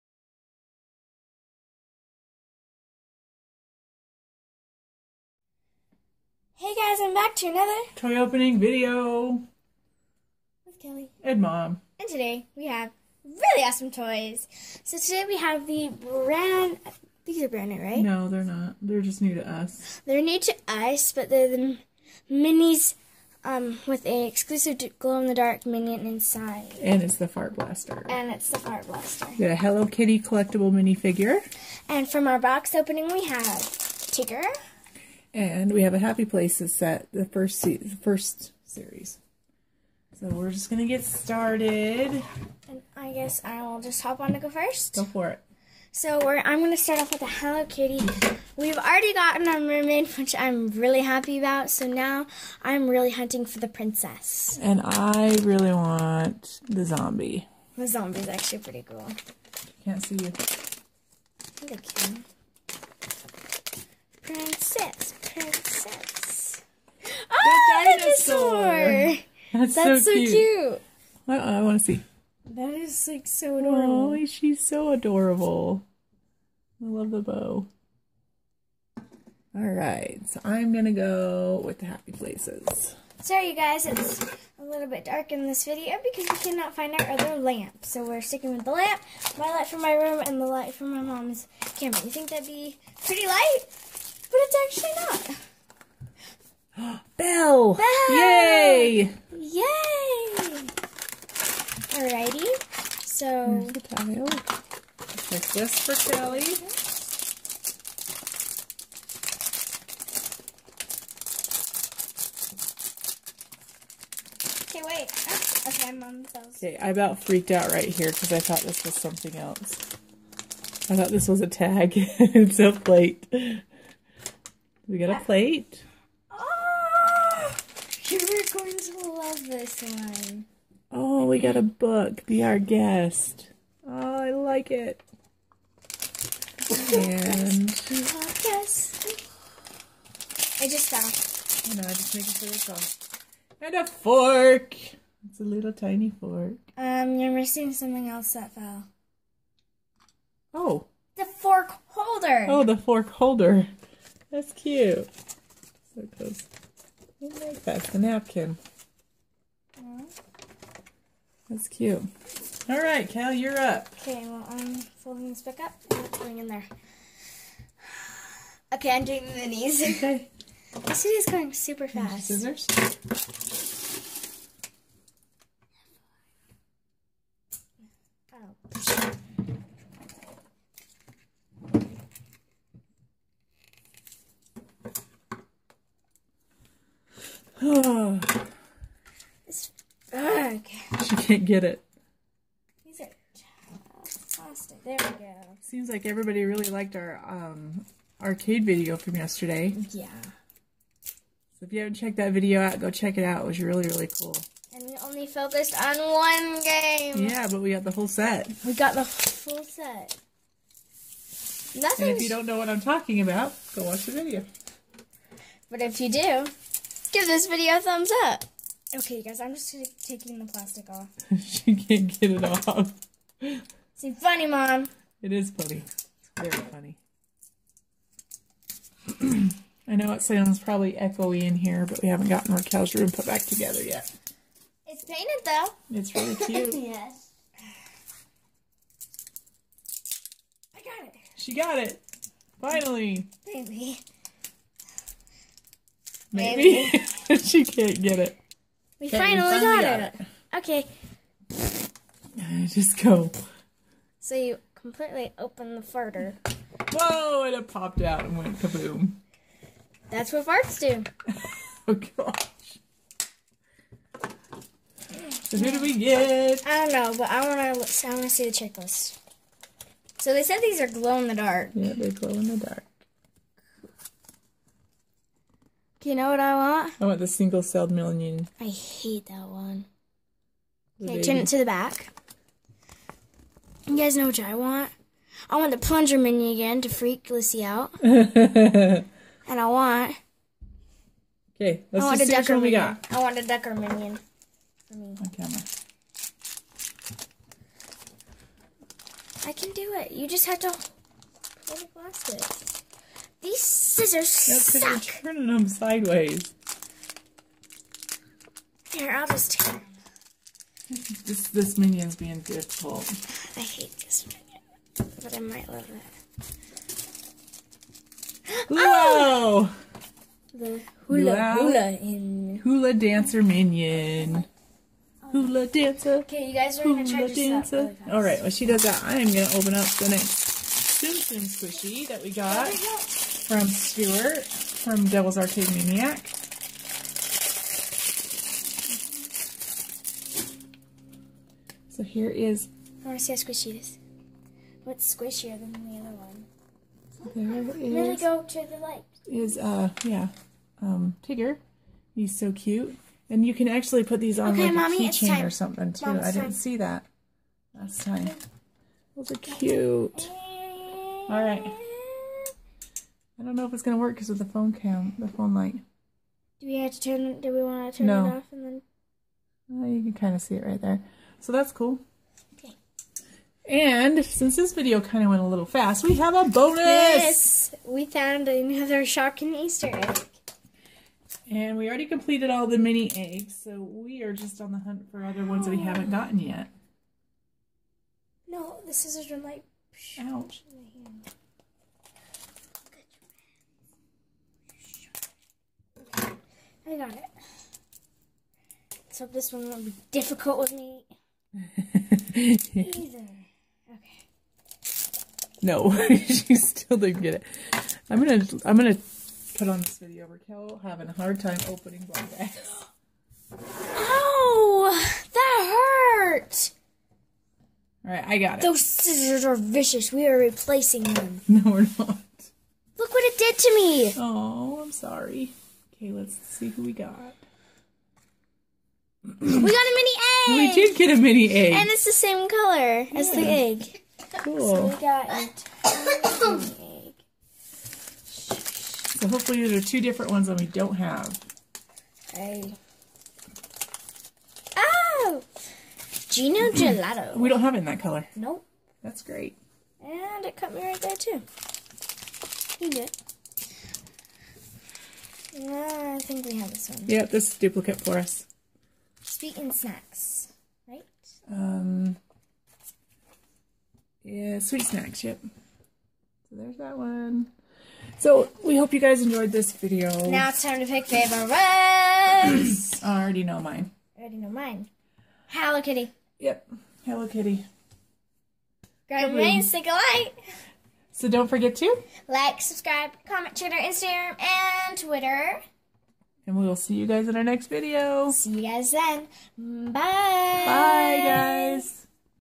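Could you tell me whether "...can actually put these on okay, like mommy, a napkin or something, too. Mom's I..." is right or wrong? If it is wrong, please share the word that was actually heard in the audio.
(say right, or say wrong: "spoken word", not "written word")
wrong: "keychain", not "napkin".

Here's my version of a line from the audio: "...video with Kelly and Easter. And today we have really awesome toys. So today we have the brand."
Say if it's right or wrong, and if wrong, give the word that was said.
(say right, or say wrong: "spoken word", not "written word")
wrong: "Mom", not "Easter".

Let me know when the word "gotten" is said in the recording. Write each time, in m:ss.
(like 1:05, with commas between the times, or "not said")
0:49, 3:52, 6:26.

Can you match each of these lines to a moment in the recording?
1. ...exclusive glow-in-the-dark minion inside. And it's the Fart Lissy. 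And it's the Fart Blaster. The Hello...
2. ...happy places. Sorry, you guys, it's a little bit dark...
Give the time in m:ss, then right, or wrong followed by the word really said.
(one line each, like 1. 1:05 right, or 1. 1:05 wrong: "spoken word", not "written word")
1. 0:24 wrong: "Blaster", not "Lissy"
2. 1:21 right.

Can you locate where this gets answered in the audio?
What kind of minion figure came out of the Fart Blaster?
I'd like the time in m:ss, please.
5:22.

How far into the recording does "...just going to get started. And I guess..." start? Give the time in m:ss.
0:40.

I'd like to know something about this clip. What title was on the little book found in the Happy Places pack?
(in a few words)
Be Our Guest.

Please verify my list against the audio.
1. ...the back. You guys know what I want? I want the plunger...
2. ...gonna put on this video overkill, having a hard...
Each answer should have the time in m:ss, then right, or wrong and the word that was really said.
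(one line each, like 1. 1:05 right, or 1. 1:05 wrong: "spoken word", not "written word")
1. 4:41 right
2. 6:48 right.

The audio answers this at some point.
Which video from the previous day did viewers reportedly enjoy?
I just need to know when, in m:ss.
3:18.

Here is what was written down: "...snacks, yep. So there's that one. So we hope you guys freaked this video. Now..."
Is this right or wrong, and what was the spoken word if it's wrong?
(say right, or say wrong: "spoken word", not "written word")
wrong: "enjoyed", not "freaked".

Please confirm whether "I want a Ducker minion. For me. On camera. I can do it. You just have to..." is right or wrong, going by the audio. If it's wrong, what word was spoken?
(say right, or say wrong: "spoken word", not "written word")
right.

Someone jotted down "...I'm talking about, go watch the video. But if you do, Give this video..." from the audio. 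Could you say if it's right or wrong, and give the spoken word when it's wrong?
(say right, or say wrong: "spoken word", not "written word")
right.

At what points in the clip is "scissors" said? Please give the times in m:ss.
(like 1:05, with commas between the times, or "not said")
2:52, 5:03, 6:28, 6:58.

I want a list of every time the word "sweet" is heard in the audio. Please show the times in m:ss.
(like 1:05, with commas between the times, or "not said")
7:39, 7:44.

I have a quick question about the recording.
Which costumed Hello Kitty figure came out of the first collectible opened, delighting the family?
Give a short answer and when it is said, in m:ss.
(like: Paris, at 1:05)
Dinosaur, at 1:07.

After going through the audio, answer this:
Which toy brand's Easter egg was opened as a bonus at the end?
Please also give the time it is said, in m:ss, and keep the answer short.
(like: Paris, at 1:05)
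Shopkins, at 6:19.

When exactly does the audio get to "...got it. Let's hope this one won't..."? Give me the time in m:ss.
6:36.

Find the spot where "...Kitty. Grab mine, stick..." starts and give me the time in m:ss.
7:57.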